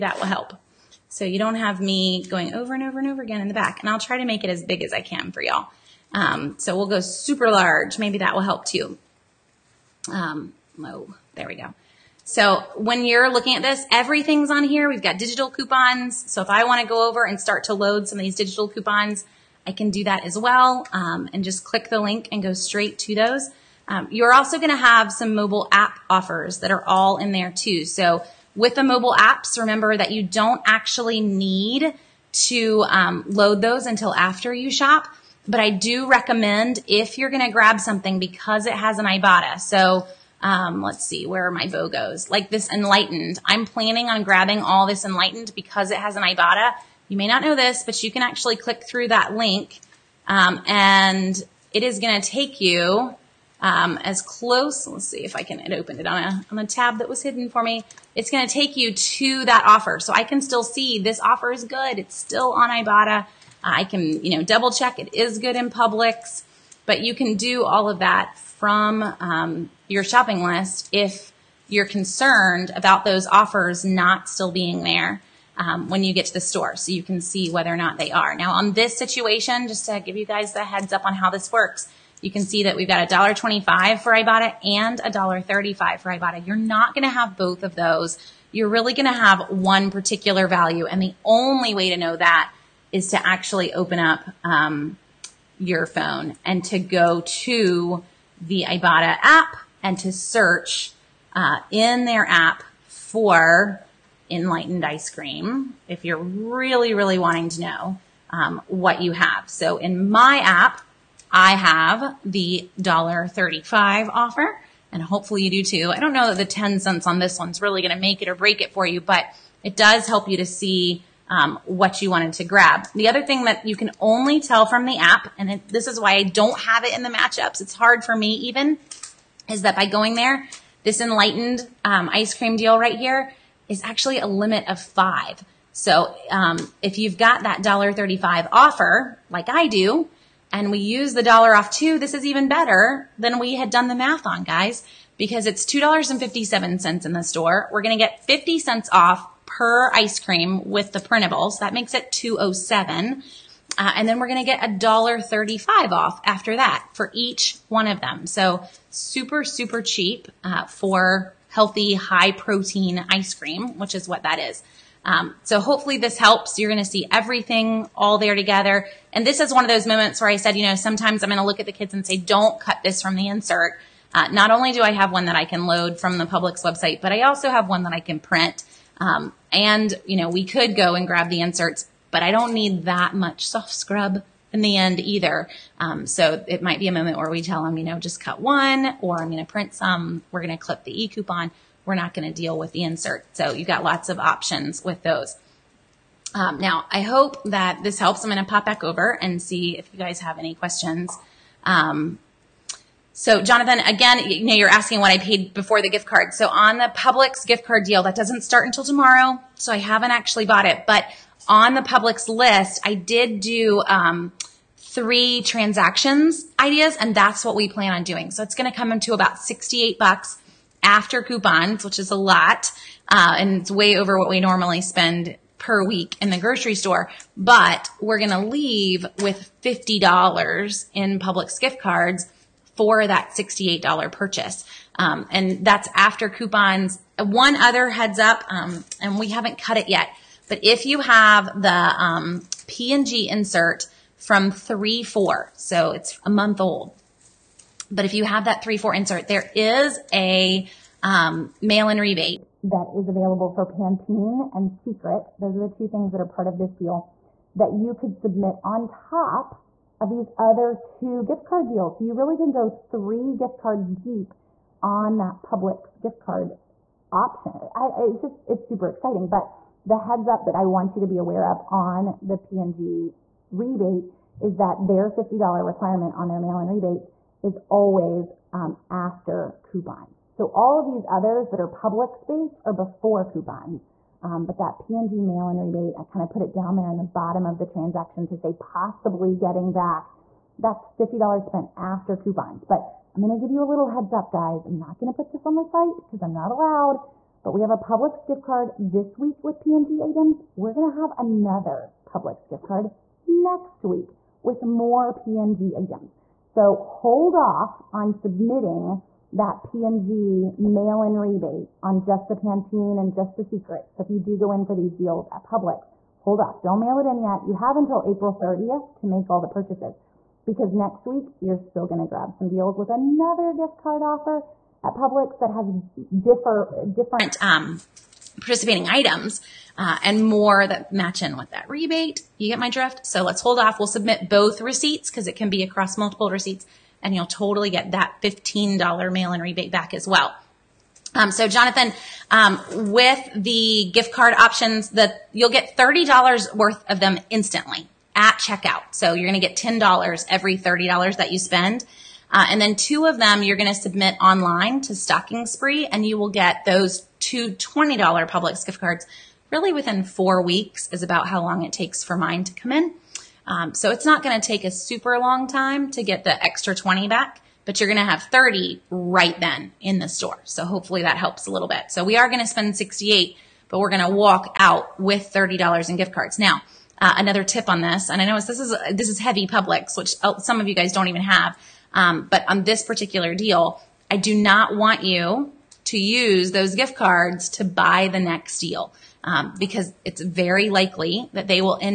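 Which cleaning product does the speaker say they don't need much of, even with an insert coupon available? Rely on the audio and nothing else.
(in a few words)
Soft Scrub.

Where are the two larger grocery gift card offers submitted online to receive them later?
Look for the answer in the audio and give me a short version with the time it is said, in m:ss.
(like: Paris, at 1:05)
Stocking Spree, at 5:54.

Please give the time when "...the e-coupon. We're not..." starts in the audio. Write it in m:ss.
3:10.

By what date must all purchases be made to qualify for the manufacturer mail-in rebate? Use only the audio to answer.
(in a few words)
April 30.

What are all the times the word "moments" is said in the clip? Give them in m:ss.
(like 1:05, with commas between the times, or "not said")
2:49, 3:06.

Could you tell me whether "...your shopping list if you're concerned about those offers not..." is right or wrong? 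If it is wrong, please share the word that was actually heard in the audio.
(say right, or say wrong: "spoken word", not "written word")
right.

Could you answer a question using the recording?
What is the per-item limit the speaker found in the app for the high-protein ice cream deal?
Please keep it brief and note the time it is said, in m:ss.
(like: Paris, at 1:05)
5, at 2:14.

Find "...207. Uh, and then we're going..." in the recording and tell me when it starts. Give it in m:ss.
2:32.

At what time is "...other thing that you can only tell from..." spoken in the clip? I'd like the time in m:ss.
2:03.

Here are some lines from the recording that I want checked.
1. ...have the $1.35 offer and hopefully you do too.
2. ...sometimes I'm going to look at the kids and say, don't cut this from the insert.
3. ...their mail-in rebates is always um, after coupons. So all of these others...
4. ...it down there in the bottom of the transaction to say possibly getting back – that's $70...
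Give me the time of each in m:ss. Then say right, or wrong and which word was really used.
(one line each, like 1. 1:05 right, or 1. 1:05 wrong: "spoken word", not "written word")
1. 1:51 right
2. 2:50 right
3. 4:36 right
4. 4:46 wrong: "50", not "70".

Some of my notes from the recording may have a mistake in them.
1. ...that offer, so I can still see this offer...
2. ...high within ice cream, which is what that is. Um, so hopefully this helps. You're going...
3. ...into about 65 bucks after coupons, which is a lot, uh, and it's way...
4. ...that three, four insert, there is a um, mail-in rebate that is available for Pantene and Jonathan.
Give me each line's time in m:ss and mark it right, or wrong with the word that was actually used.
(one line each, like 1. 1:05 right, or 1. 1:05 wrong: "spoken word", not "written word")
1. 0:59 right
2. 2:41 wrong: "protein", not "within"
3. 3:38 wrong: "68", not "65"
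4. 4:08 wrong: "Secret", not "Jonathan".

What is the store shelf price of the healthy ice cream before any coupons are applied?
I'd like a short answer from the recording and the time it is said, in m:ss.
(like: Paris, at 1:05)
$2.57, at 2:25.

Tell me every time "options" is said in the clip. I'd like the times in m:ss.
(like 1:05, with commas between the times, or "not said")
3:14, 4:27, 5:44.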